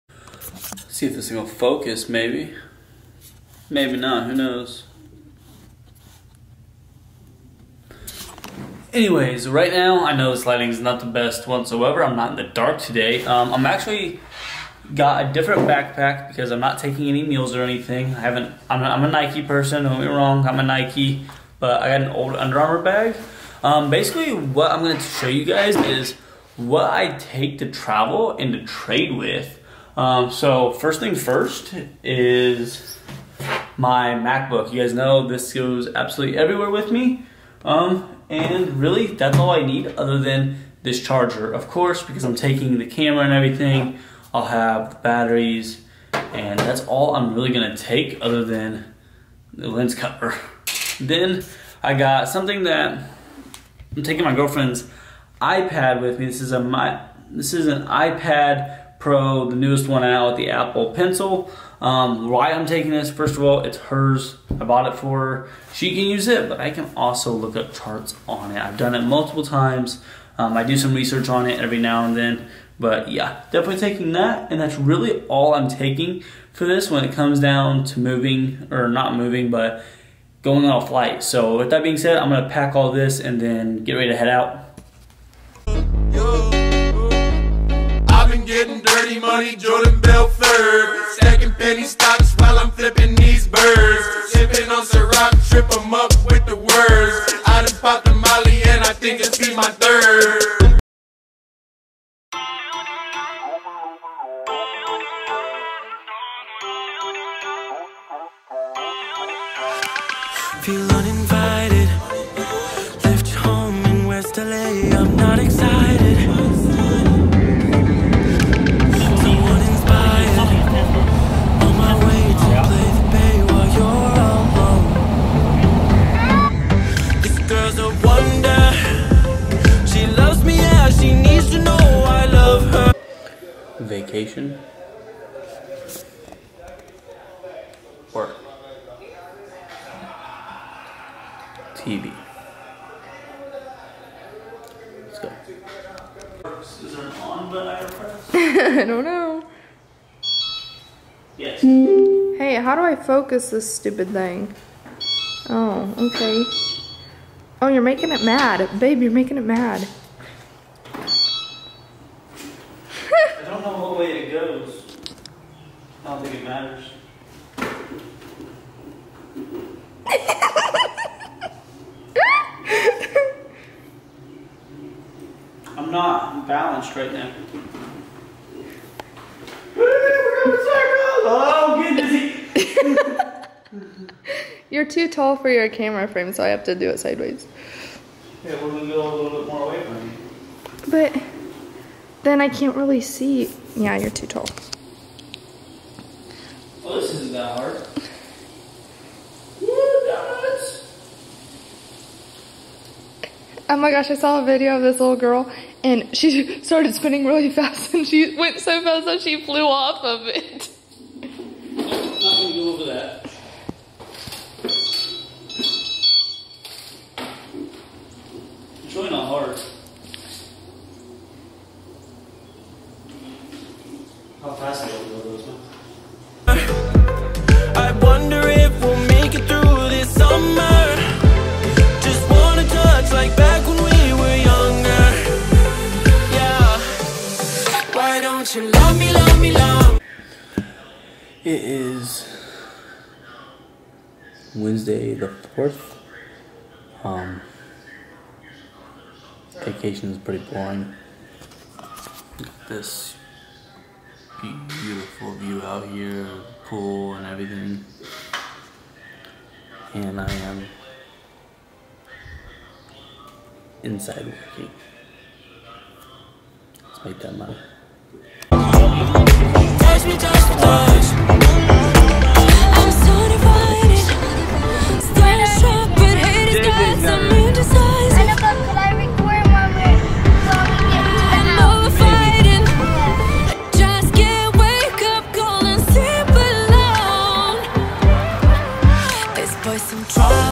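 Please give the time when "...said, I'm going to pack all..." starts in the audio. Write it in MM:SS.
01:21.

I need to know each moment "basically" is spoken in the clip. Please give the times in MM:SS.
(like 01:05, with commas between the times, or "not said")
00:23.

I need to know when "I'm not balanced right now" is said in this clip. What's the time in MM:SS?
02:55.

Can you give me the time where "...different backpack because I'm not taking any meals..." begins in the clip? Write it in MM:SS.
00:15.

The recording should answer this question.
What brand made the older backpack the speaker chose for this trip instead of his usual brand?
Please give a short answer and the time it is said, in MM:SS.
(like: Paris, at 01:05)
Under Armour, at 00:22.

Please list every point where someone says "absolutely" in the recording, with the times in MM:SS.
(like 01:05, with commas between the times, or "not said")
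00:35.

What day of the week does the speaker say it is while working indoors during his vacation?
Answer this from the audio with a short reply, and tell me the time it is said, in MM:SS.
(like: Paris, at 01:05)
Wednesday, at 04:04.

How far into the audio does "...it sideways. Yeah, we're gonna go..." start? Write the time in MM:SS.
03:06.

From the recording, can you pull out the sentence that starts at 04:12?
this beautiful view out here, pool and everything.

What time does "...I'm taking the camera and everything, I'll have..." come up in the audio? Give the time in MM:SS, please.
00:42.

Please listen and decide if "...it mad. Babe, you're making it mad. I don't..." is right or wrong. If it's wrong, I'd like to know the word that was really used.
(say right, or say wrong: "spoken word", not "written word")
right.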